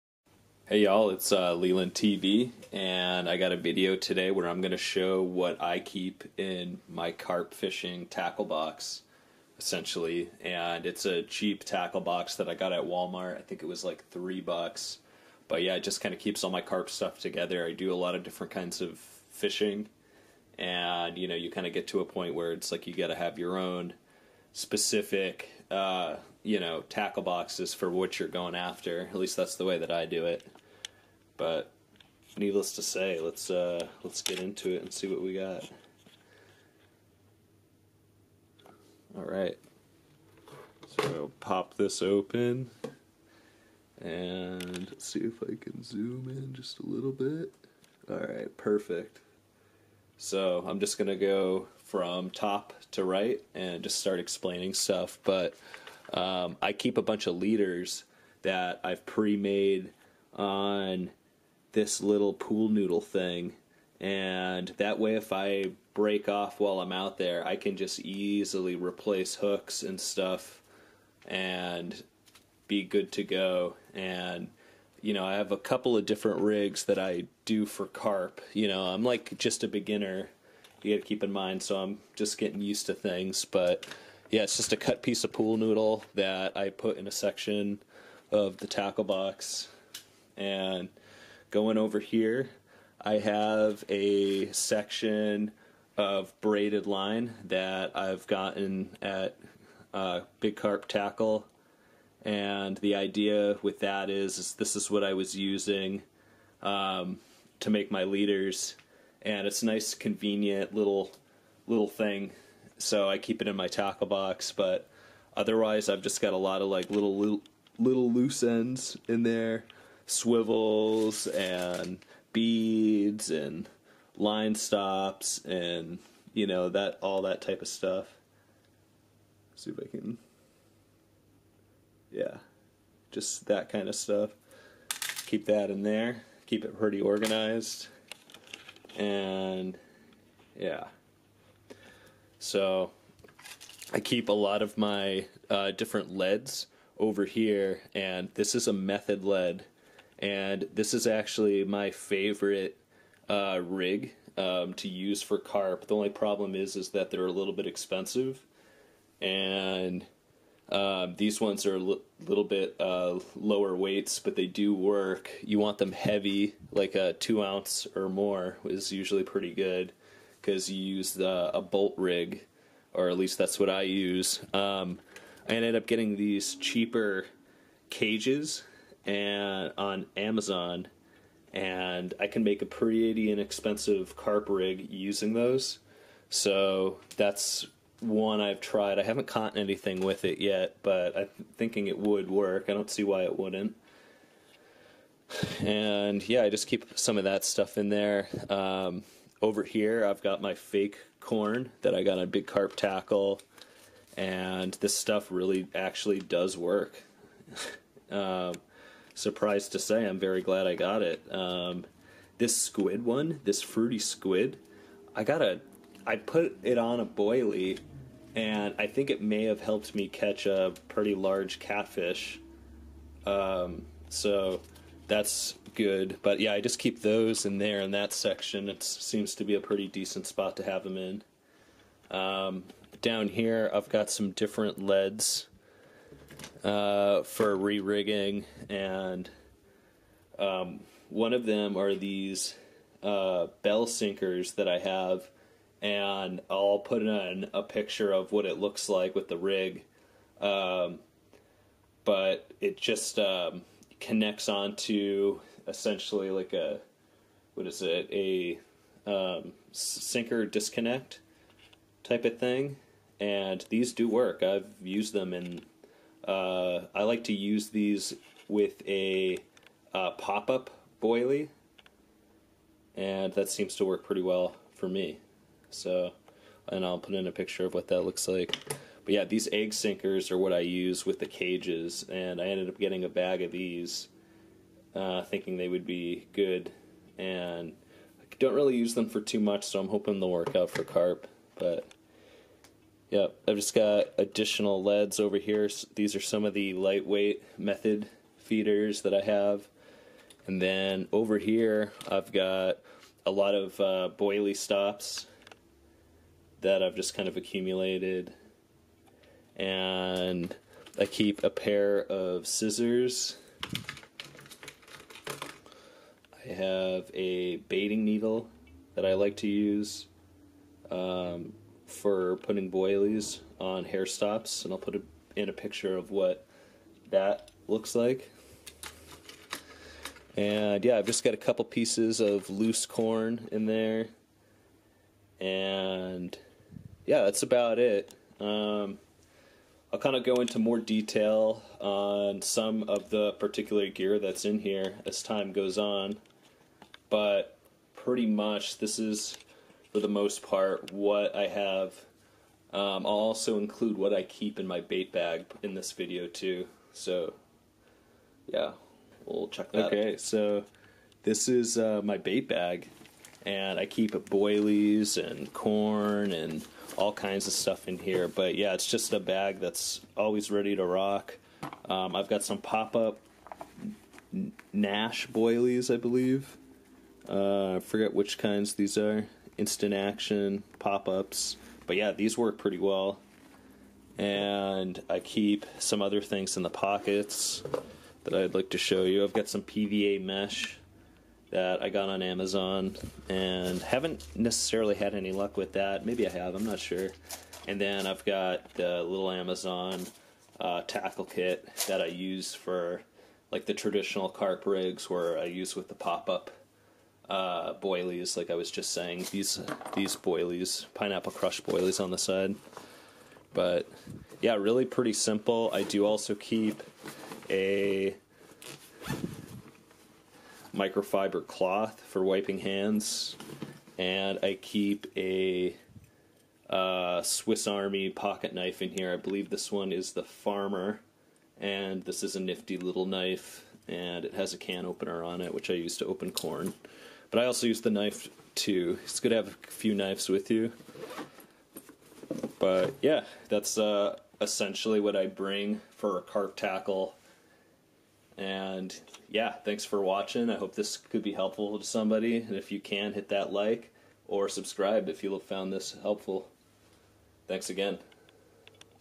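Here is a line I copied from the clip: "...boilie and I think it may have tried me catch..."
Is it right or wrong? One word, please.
wrong.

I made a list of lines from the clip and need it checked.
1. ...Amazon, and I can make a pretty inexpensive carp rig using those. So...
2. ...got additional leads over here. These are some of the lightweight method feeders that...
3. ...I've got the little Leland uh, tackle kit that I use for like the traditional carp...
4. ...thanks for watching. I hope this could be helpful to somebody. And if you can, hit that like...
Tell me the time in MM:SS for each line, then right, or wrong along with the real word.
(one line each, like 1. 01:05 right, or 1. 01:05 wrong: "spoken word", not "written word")
1. 03:00 right
2. 04:53 right
3. 06:38 wrong: "Amazon", not "Leland"
4. 07:29 right.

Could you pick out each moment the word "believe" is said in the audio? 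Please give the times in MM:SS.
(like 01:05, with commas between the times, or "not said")
06:15, 07:09.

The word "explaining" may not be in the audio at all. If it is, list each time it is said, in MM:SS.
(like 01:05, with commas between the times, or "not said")
00:54.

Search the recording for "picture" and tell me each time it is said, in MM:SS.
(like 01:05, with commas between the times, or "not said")
04:07, 04:37, 05:25.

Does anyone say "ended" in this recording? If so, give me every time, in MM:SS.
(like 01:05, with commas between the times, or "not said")
02:55, 04:42.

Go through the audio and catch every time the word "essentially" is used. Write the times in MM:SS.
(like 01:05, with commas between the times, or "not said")
00:09, 04:15, 07:24.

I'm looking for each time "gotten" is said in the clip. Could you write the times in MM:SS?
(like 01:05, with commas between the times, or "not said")
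01:38.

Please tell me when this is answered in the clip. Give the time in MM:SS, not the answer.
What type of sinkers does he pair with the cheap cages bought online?
04:39.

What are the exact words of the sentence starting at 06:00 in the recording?
Okay, so this is uh, my bait bag and I keep boilies and corn and all kinds of stuff in here.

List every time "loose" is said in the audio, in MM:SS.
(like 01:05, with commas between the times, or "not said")
01:58, 05:32.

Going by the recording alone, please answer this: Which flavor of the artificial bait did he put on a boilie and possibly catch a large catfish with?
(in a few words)
Fruity squid.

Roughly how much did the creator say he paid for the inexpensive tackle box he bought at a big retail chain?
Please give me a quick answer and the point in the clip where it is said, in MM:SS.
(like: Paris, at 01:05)
3 bucks, at 00:14.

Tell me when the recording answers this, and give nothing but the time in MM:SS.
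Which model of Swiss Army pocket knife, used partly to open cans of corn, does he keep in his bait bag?
07:10.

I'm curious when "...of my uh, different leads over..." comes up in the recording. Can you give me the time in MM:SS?
02:24.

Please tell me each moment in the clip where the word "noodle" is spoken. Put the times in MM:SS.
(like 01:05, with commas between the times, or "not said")
01:02, 01:25.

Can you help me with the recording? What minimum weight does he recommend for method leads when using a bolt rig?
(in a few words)
2 ounces.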